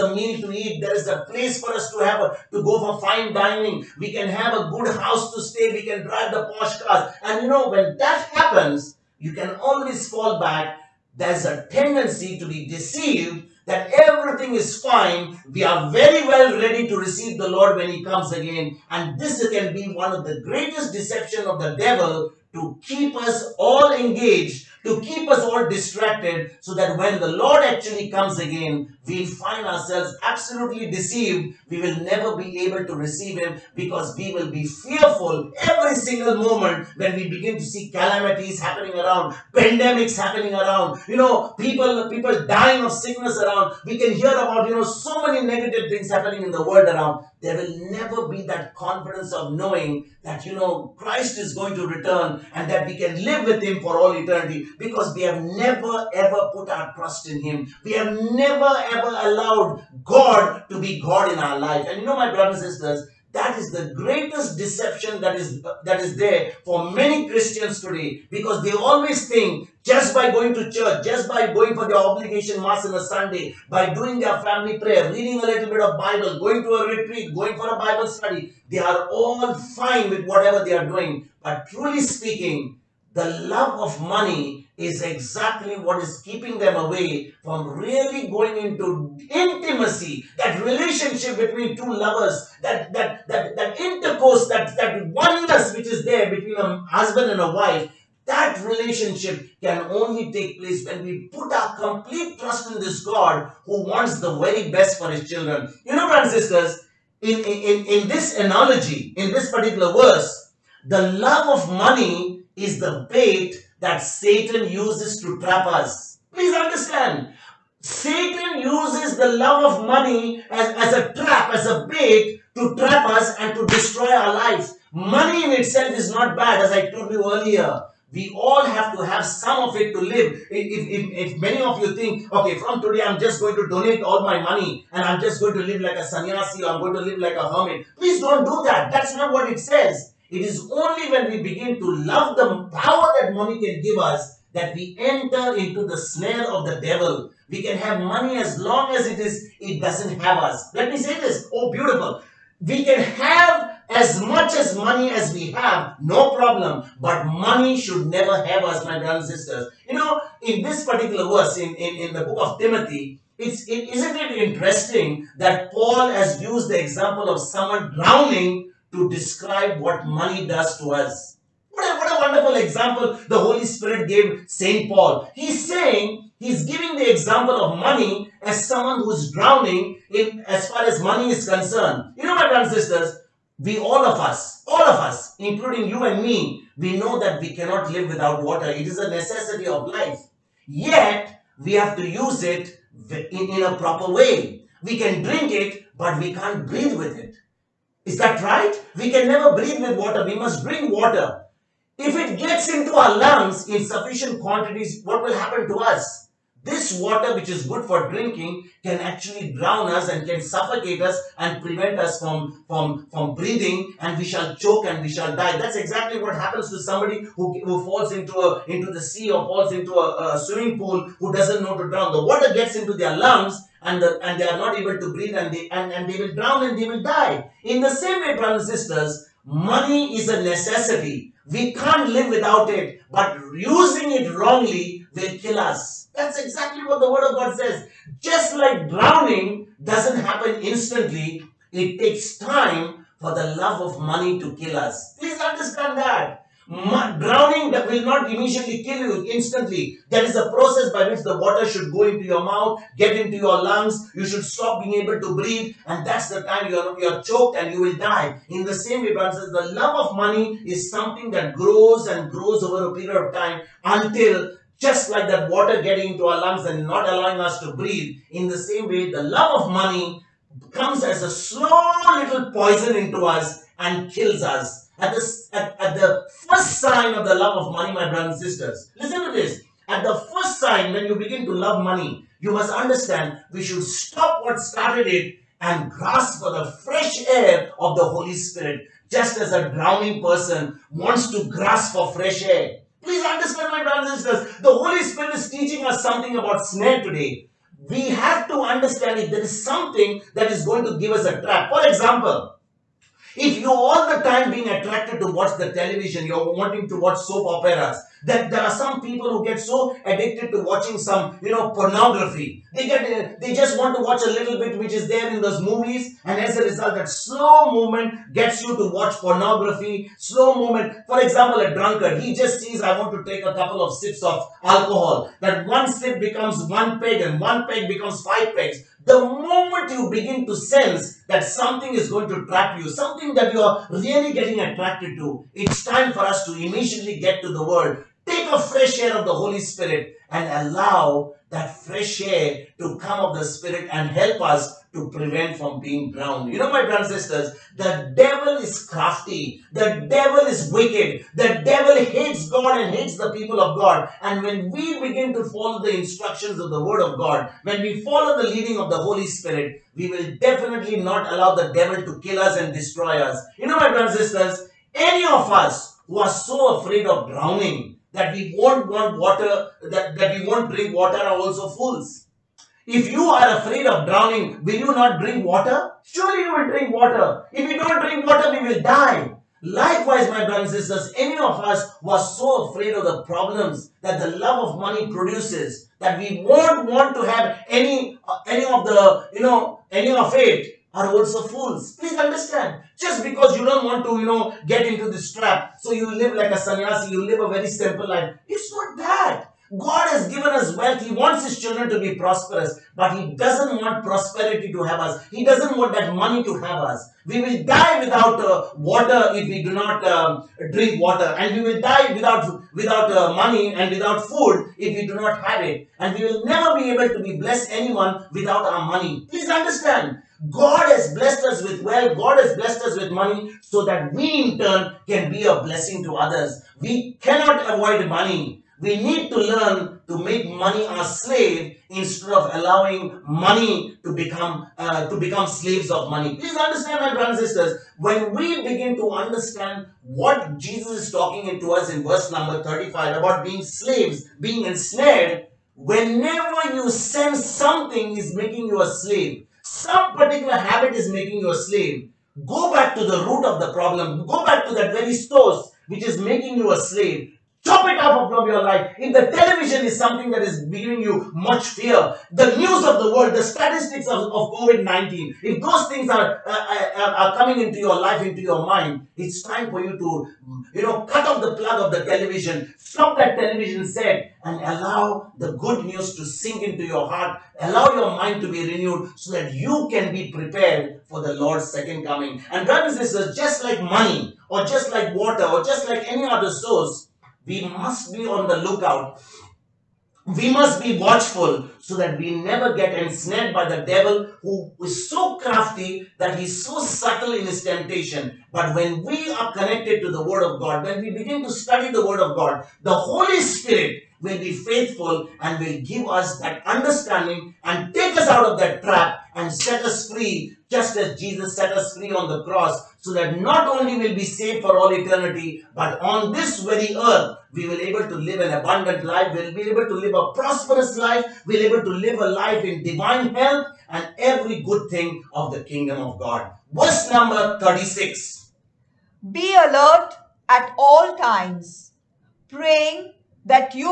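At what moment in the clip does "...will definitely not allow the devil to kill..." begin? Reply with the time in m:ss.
6:00.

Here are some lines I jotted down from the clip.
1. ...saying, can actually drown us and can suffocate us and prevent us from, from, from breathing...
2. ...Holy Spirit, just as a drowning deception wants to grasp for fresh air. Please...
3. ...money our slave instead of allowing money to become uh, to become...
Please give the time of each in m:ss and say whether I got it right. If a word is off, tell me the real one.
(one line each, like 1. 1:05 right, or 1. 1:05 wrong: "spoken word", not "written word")
1. 3:28 wrong: "drinking", not "saying"
2. 4:48 wrong: "person", not "deception"
3. 7:10 right.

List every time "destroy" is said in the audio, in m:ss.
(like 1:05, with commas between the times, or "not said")
2:03, 6:02.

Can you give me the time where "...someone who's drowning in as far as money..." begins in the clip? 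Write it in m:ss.
2:58.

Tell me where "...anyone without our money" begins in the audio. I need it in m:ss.
6:57.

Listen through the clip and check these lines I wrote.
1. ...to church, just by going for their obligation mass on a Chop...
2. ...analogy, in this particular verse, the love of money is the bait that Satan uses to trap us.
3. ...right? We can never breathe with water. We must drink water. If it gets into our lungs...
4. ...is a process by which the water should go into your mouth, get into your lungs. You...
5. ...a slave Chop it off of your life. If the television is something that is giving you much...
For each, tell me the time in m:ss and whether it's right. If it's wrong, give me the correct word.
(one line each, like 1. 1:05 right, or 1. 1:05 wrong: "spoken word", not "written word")
1. 1:10 wrong: "Sunday", not "Chop"
2. 1:48 right
3. 3:18 right
4. 4:10 right
5. 7:36 right.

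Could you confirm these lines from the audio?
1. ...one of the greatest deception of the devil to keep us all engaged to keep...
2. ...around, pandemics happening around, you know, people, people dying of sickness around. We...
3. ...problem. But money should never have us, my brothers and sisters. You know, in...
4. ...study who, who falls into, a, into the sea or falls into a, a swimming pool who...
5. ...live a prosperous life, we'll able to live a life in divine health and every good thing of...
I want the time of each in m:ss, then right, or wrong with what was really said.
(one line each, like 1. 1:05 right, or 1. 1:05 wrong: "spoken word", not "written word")
1. 0:19 right
2. 0:38 right
3. 2:36 right
4. 3:36 wrong: "somebody", not "study"
5. 8:39 right.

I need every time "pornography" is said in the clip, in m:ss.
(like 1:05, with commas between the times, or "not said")
5:11, 5:19.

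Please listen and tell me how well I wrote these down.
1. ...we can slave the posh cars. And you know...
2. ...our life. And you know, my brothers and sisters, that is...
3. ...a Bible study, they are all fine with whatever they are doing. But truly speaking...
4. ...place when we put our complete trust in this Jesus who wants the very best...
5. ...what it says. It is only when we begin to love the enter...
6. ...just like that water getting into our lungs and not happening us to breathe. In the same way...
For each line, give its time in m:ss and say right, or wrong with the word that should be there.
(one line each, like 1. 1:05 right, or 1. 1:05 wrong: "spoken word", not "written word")
1. 0:05 wrong: "drive", not "slave"
2. 1:01 right
3. 1:17 right
4. 1:40 wrong: "God", not "Jesus"
5. 2:19 wrong: "power", not "enter"
6. 4:24 wrong: "allowing", not "happening".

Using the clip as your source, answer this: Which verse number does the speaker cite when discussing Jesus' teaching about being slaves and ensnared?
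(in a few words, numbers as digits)
35.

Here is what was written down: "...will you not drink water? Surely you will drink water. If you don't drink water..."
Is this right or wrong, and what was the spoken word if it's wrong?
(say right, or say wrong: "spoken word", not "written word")
right.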